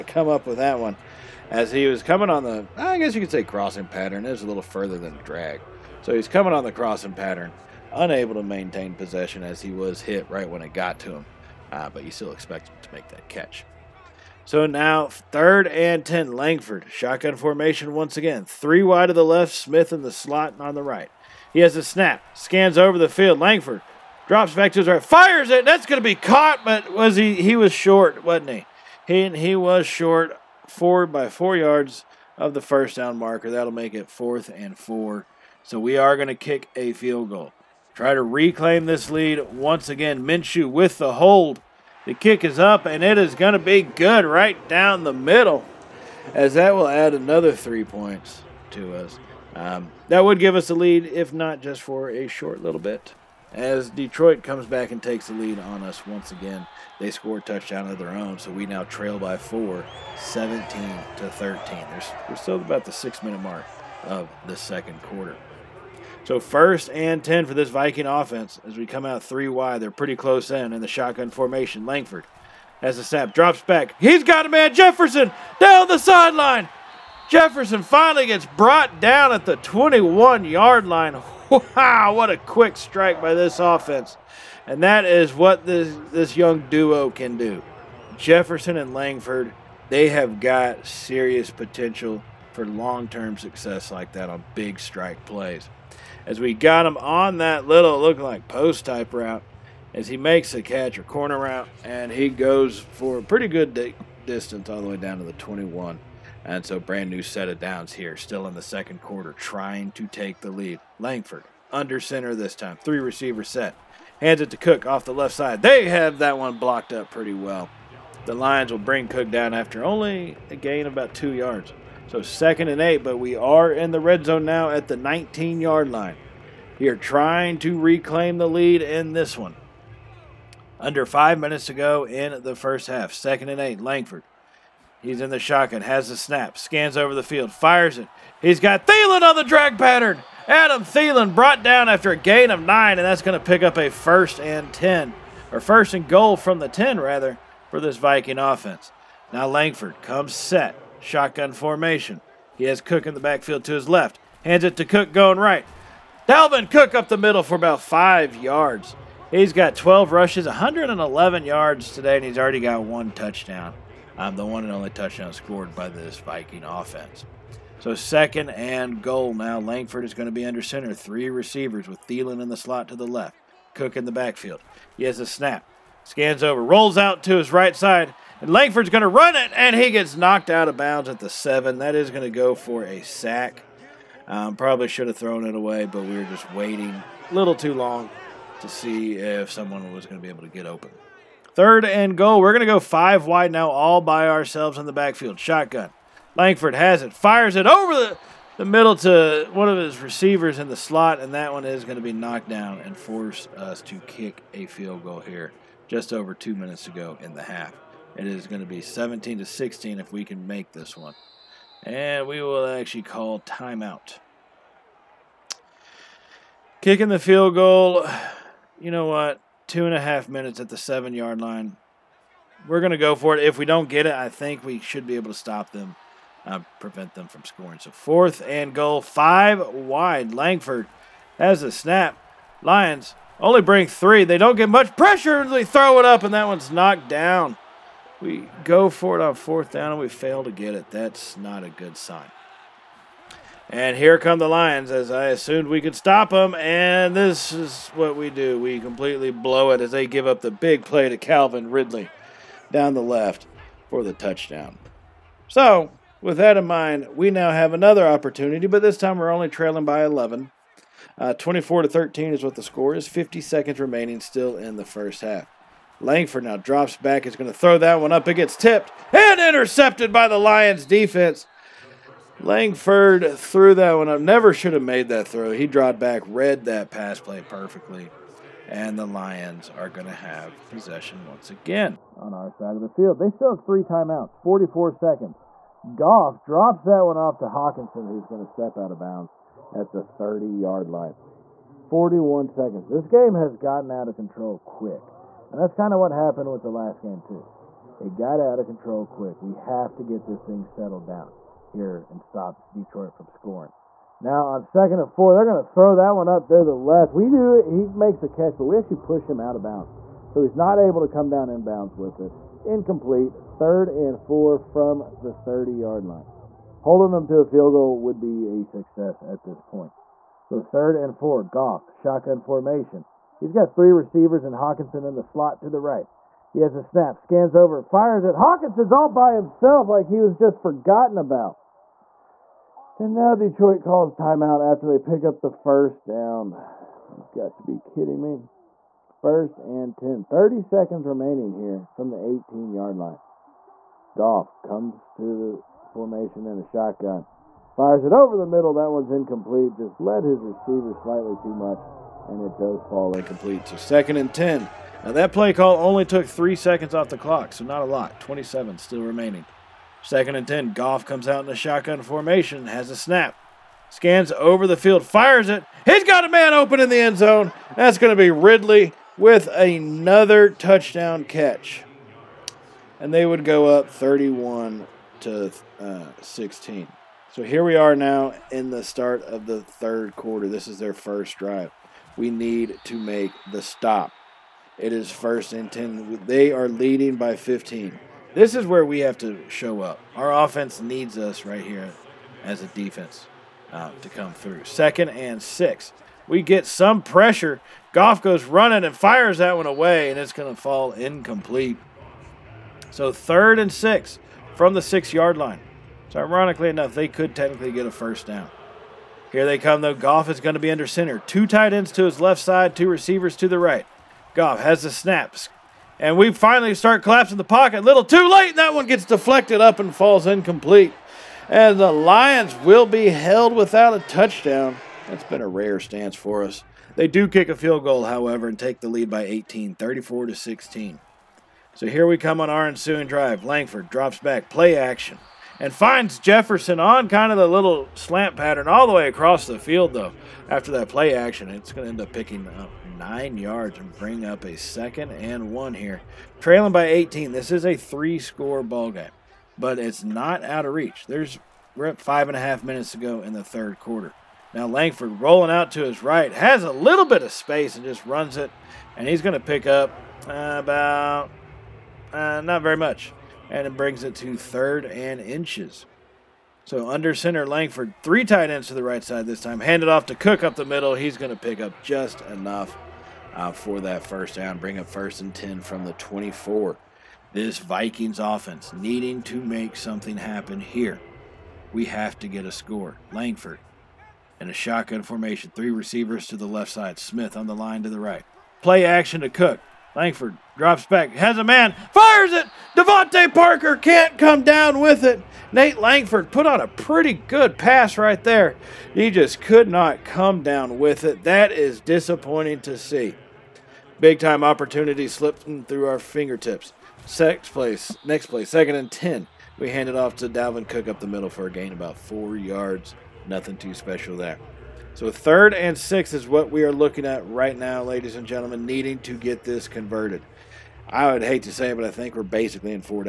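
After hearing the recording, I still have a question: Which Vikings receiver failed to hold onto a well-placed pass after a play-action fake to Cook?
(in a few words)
DeVante Parker.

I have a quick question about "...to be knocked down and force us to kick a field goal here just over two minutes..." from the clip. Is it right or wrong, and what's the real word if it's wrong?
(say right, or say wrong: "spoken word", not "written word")
right.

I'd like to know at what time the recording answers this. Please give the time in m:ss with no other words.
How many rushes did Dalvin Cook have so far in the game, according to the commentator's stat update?
2:39.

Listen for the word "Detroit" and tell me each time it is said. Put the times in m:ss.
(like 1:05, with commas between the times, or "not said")
0:53, 5:02, 5:33.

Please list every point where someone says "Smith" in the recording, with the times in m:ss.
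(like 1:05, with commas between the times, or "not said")
0:19, 8:06.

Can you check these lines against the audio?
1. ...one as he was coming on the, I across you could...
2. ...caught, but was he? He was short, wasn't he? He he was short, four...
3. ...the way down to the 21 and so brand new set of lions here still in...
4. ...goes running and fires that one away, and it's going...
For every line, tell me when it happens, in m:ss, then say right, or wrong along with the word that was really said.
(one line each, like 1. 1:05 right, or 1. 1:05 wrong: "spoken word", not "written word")
1. 0:00 wrong: "guess", not "across"
2. 0:26 right
3. 1:44 wrong: "downs", not "lions"
4. 6:38 right.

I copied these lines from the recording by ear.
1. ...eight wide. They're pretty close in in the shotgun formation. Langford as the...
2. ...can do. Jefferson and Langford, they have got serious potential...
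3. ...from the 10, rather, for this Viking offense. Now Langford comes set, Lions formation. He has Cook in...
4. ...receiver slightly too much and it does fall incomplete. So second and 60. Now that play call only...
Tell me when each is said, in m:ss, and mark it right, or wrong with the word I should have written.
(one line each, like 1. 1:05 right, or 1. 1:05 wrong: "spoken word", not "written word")
1. 1:09 wrong: "three", not "eight"
2. 1:27 right
3. 2:26 wrong: "Shotgun", not "Lions"
4. 5:50 wrong: "10", not "60".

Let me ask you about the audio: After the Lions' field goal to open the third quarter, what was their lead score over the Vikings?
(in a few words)
34 to 16.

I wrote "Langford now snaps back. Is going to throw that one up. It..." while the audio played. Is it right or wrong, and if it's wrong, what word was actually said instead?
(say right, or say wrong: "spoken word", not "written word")
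wrong: "drops", not "snaps".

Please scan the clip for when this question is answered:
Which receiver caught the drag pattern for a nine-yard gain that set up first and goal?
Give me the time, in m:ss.
2:20.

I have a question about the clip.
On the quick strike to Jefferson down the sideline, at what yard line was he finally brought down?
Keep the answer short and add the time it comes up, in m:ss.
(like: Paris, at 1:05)
21, at 1:19.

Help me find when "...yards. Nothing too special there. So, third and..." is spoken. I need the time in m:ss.
8:32.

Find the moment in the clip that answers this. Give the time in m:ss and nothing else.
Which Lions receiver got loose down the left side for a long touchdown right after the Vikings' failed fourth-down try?
4:11.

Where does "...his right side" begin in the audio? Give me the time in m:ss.
2:57.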